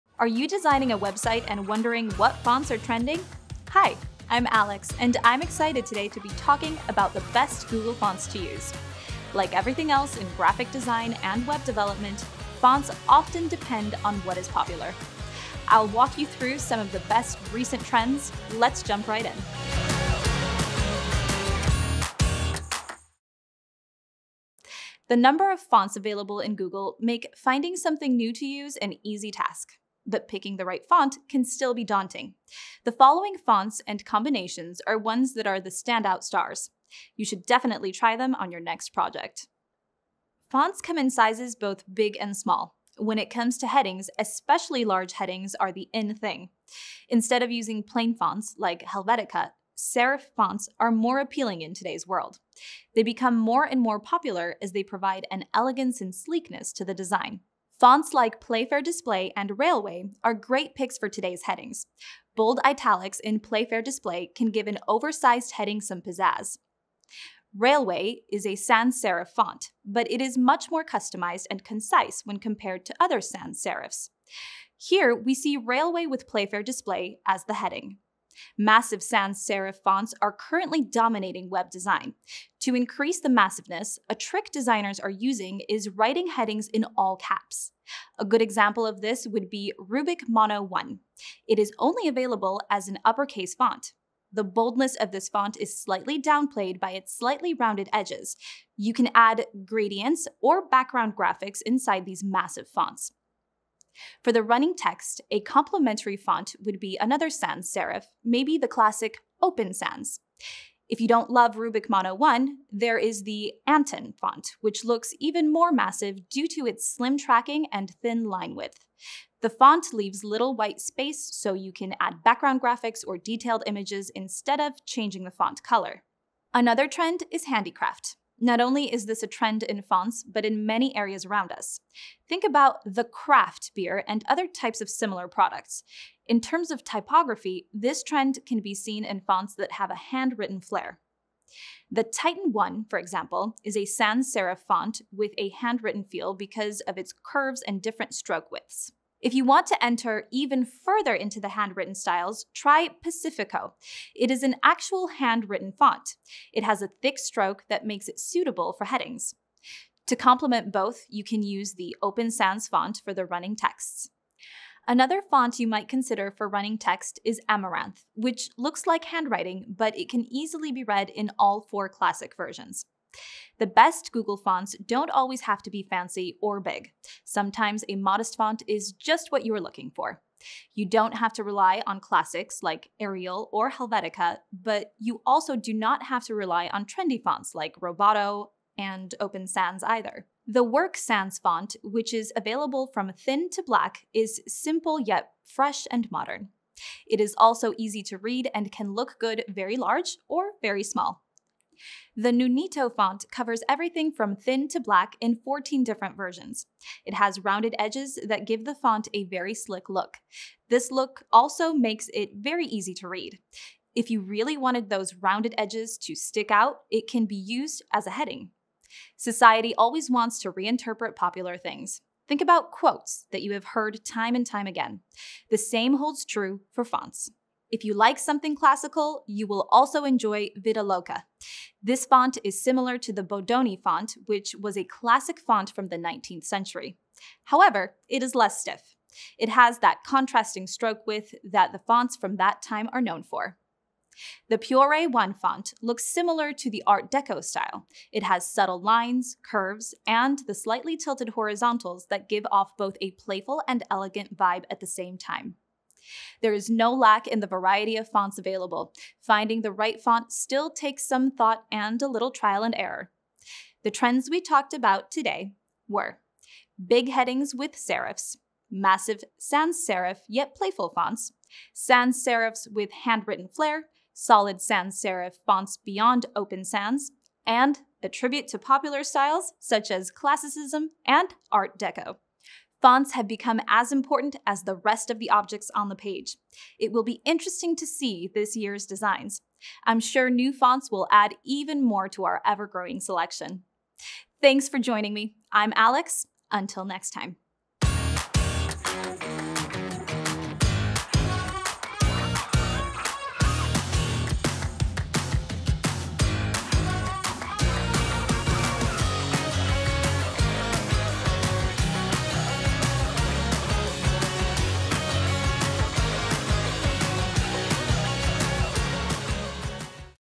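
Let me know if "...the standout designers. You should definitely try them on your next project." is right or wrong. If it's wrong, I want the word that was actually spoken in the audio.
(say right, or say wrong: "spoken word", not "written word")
wrong: "stars", not "designers".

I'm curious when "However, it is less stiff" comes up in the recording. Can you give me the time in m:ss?
3:57.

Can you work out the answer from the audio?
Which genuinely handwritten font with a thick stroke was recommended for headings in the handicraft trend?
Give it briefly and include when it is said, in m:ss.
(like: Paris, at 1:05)
Pacifico, at 2:33.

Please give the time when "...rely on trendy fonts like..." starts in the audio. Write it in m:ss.
3:06.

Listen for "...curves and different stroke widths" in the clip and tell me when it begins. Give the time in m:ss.
2:27.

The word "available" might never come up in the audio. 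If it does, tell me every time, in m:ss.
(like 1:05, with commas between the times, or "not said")
0:25, 1:32, 3:12, 4:18.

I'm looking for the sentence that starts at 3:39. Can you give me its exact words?
Society always wants to reinterpret popular things.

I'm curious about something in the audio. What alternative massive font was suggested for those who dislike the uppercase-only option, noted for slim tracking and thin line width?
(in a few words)
Anton.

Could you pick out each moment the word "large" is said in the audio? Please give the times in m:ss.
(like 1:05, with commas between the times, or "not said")
0:44, 3:19.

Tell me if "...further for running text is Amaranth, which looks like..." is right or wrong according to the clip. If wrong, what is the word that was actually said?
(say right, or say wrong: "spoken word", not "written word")
wrong: "consider", not "further".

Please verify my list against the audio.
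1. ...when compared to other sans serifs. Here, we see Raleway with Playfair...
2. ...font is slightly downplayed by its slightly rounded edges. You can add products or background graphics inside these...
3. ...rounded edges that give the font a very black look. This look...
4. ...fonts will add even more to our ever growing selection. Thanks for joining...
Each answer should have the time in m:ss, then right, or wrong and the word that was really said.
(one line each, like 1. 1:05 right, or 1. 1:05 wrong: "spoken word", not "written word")
1. 1:12 right
2. 1:35 wrong: "gradients", not "products"
3. 3:27 wrong: "slick", not "black"
4. 4:50 right.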